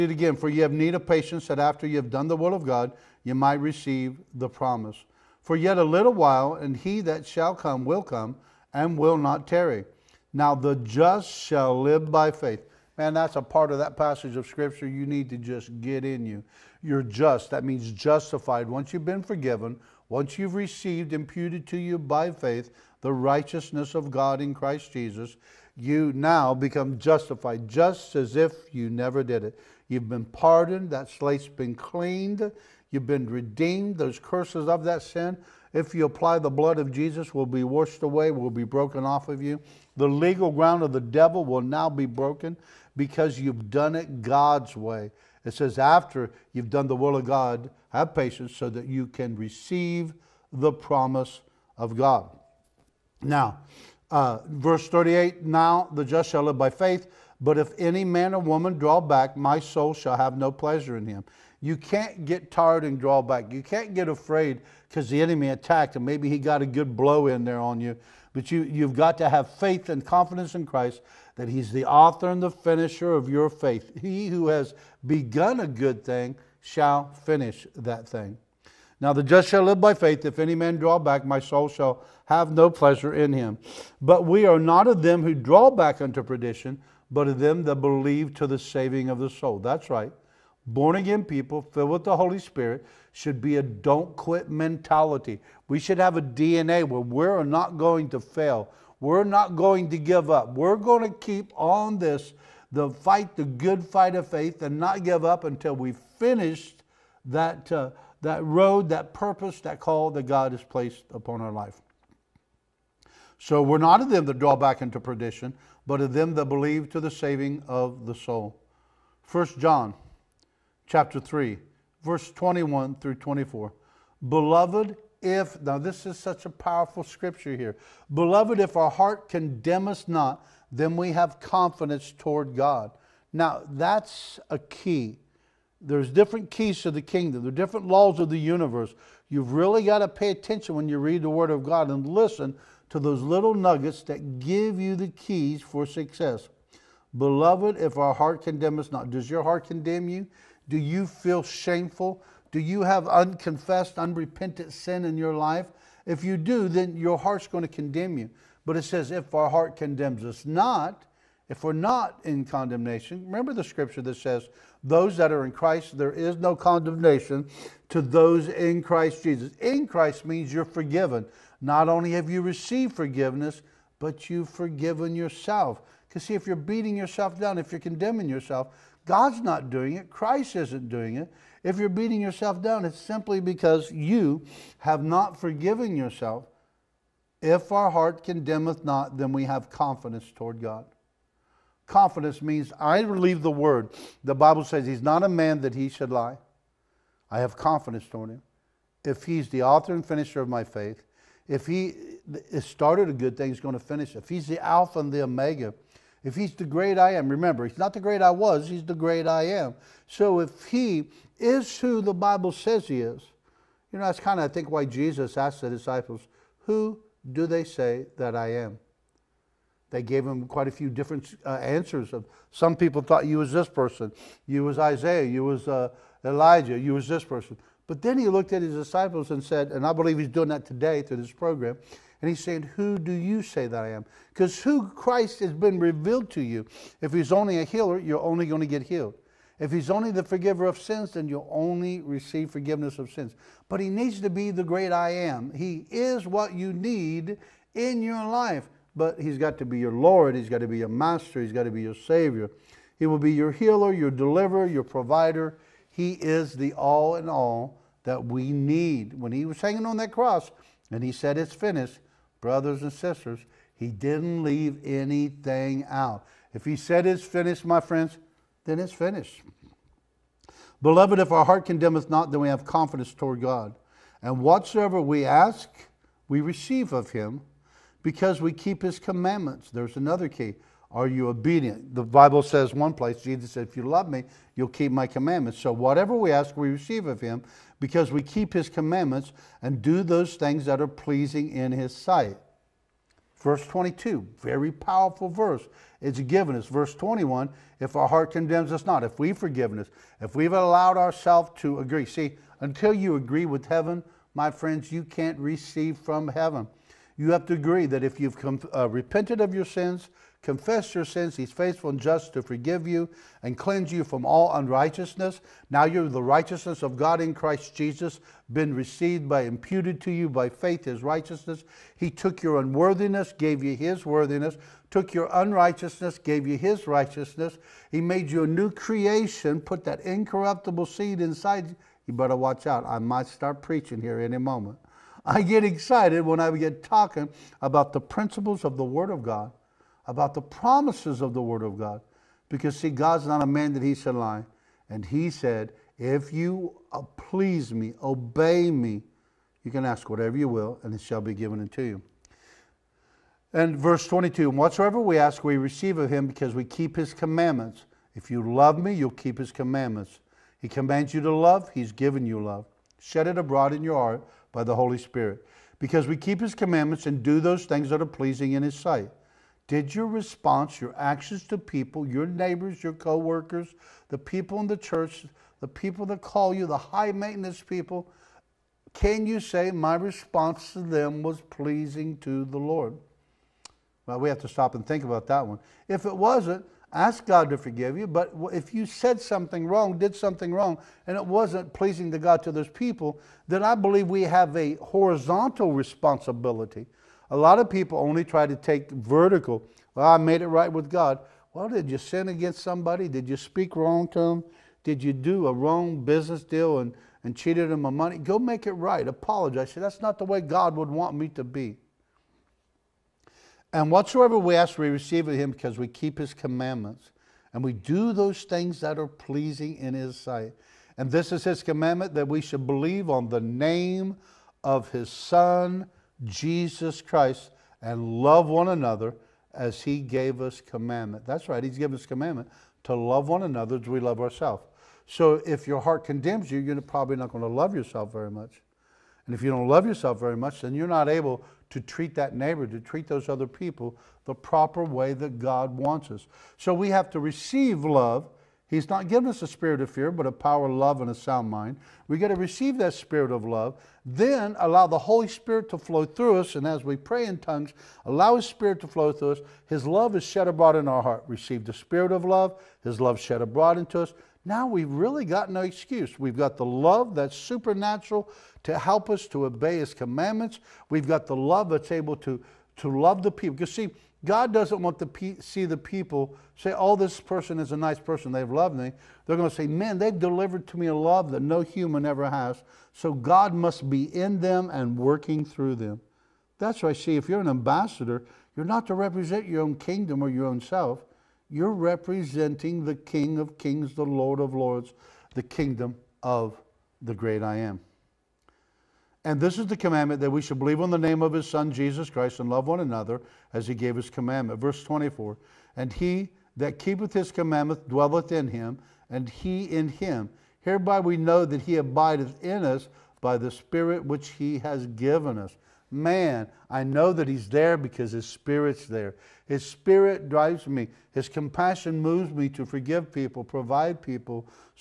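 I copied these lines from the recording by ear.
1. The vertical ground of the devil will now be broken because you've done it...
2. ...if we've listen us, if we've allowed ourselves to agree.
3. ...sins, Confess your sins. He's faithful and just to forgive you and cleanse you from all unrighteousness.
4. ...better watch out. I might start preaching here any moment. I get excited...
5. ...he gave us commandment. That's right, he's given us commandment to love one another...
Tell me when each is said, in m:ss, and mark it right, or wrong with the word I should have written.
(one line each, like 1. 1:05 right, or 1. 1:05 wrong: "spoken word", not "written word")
1. 0:39 wrong: "legal", not "vertical"
2. 4:59 wrong: "forgiven", not "listen"
3. 5:09 right
4. 5:32 right
5. 7:09 right.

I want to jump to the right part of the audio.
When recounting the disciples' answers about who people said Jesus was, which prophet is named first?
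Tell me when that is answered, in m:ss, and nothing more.
3:44.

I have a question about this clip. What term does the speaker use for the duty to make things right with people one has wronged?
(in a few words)
horizontal responsibility.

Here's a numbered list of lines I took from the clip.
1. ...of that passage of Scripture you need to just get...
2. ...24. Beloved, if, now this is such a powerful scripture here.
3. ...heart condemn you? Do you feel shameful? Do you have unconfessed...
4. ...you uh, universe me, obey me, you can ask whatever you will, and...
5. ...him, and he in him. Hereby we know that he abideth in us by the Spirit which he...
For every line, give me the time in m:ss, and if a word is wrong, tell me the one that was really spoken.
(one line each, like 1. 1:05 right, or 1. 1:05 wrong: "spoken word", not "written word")
1. 0:13 right
2. 2:03 right
3. 2:29 right
4. 5:46 wrong: "please", not "universe"
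5. 8:28 right.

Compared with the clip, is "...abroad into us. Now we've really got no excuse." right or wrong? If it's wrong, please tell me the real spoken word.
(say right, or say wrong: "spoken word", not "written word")
right.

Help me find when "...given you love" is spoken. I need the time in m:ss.
6:01.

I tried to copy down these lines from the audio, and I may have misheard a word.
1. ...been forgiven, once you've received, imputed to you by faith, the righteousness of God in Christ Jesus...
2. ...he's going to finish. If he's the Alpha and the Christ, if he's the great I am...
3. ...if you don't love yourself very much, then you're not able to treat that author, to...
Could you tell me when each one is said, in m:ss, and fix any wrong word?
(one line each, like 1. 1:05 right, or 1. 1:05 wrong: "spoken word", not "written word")
1. 0:19 right
2. 3:23 wrong: "Omega", not "Christ"
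3. 7:19 wrong: "neighbor", not "author".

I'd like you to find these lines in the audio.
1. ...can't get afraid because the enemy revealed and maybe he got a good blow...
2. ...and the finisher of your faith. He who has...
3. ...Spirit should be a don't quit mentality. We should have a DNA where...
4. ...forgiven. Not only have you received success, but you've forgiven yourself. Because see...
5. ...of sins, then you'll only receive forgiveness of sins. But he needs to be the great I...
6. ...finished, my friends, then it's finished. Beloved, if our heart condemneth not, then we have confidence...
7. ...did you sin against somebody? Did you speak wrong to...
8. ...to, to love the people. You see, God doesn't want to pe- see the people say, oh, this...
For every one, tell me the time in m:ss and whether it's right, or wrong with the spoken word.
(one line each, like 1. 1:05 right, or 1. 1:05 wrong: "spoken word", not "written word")
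1. 1:03 wrong: "attacked", not "revealed"
2. 1:12 right
3. 1:32 right
4. 2:50 wrong: "forgiveness", not "success"
5. 4:00 right
6. 4:27 right
7. 6:41 right
8. 7:52 right.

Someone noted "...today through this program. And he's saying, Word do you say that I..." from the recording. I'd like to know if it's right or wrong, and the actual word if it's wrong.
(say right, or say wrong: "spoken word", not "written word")
wrong: "Who", not "Word".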